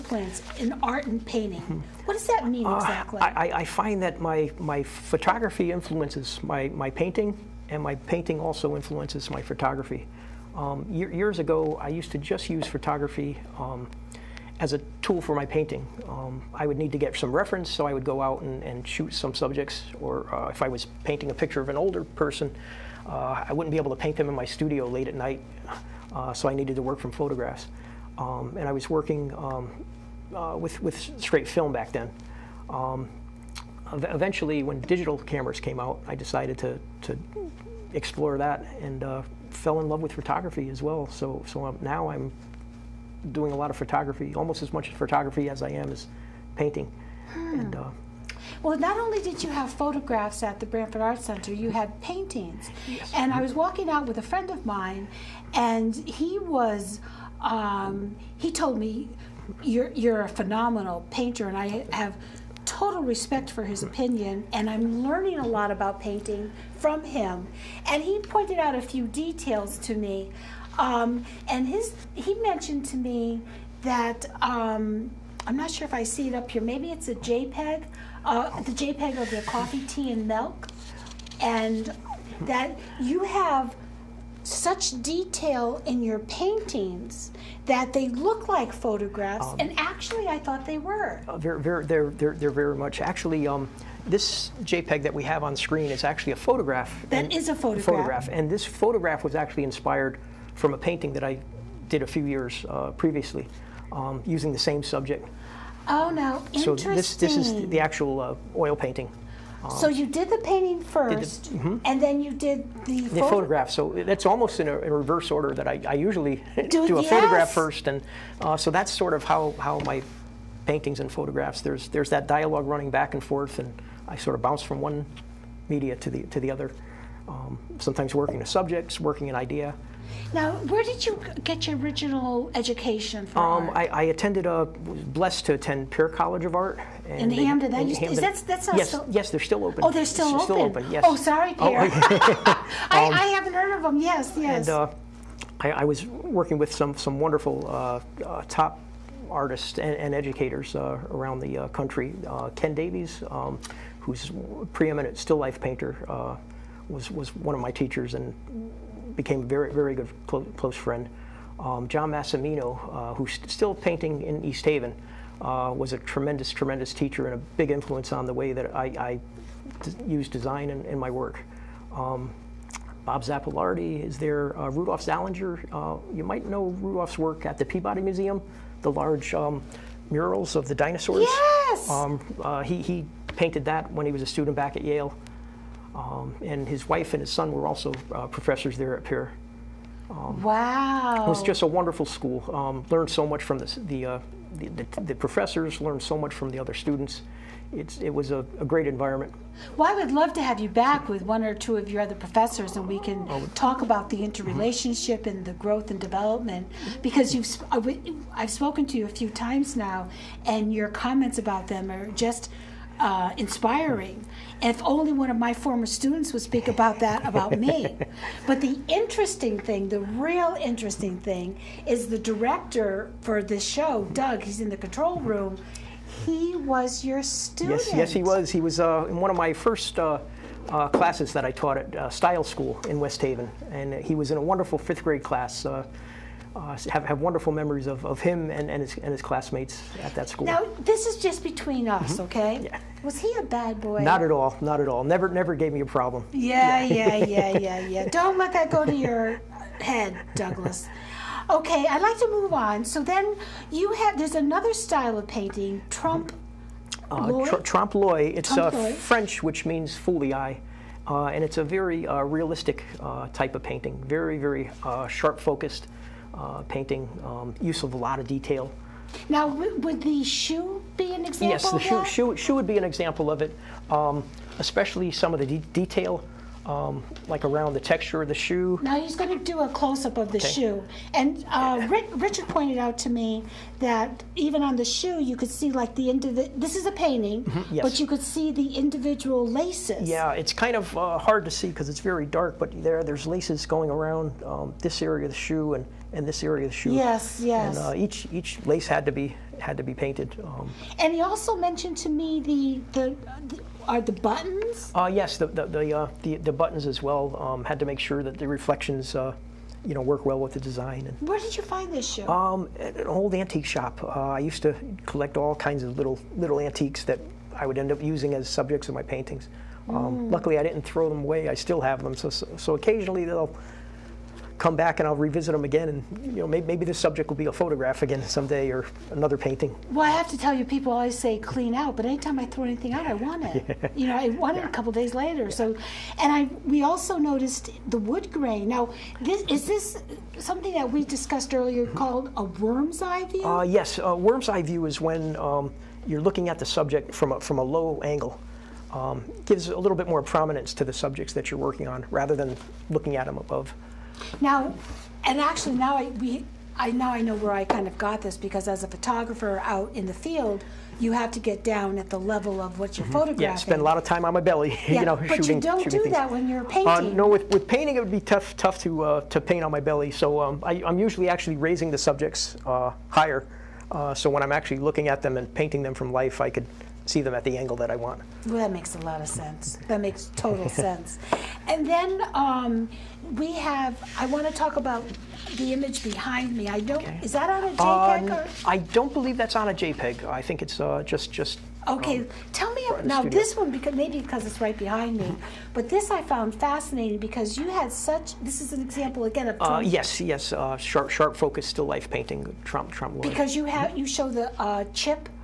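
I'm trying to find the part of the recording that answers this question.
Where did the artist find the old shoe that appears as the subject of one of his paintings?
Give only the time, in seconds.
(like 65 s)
312 s.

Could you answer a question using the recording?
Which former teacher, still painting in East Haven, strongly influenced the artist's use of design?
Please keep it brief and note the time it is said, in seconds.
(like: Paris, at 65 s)
John Massimino, at 161 s.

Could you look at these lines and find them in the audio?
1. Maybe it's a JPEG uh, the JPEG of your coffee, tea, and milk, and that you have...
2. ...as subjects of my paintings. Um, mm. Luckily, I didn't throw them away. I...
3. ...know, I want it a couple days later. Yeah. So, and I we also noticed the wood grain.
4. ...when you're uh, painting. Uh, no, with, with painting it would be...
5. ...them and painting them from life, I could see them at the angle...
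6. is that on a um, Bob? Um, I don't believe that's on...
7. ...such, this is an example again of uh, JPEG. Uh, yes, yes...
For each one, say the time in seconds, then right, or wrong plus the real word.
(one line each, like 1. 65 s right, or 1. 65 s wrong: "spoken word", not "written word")
1. 76 s right
2. 318 s right
3. 334 s right
4. 366 s right
5. 375 s right
6. 387 s wrong: "JPEG", not "Bob"
7. 397 s wrong: "Trump", not "JPEG".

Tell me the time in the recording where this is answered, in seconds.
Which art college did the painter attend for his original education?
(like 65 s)
135 s.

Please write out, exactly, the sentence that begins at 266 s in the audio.
Uh, painting, um, use of a lot of detail.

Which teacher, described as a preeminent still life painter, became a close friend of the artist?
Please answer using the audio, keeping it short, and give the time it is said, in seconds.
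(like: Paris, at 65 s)
Ken Davies, at 152 s.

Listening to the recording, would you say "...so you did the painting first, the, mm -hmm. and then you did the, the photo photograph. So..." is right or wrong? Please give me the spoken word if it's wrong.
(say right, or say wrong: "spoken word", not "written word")
right.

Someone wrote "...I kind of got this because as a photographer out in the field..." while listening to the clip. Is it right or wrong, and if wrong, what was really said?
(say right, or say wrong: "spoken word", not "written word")
right.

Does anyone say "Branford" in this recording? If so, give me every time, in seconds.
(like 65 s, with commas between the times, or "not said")
50 s.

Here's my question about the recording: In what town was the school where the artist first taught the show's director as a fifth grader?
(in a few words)
West Haven.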